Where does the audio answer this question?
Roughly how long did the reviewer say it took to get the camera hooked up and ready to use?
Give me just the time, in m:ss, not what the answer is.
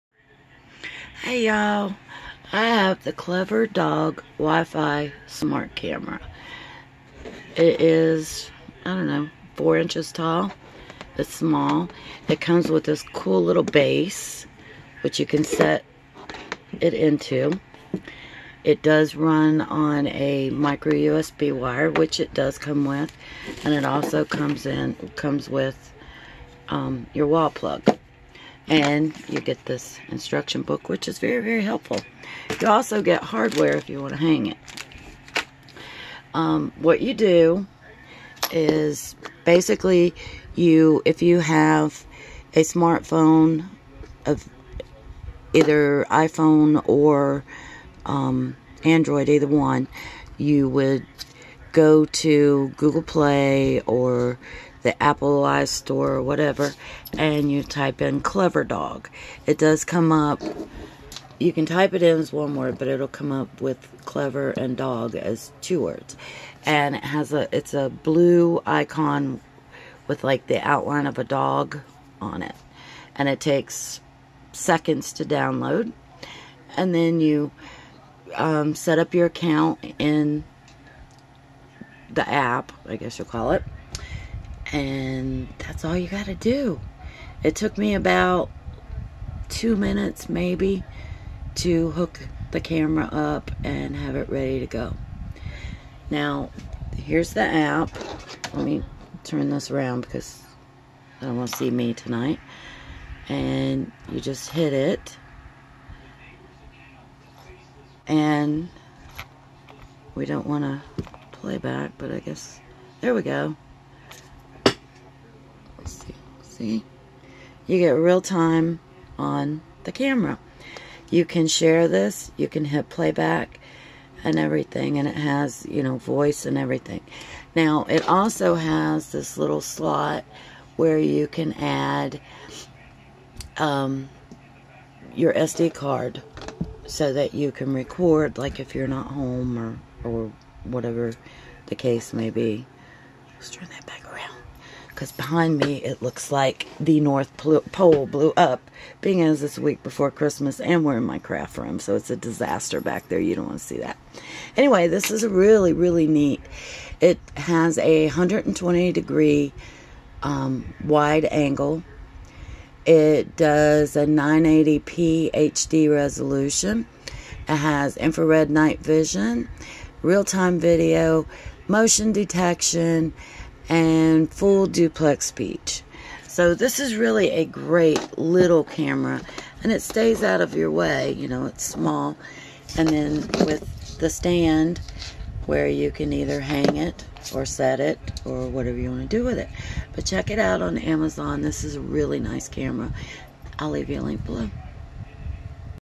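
1:29.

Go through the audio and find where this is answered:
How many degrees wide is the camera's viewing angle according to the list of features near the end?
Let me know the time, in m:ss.
2:38.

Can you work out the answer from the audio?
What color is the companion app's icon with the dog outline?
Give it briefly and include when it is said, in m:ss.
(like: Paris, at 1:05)
blue, at 1:07.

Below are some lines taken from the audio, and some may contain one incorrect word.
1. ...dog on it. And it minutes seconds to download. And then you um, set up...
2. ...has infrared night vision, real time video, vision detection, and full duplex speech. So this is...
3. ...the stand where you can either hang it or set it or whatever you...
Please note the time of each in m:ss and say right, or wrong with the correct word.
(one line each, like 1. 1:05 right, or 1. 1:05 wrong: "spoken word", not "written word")
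1. 1:11 wrong: "takes", not "minutes"
2. 2:47 wrong: "motion", not "vision"
3. 3:03 right.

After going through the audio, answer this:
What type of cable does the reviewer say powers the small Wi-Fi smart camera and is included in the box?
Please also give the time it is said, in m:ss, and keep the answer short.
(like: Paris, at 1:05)
micro USB, at 0:20.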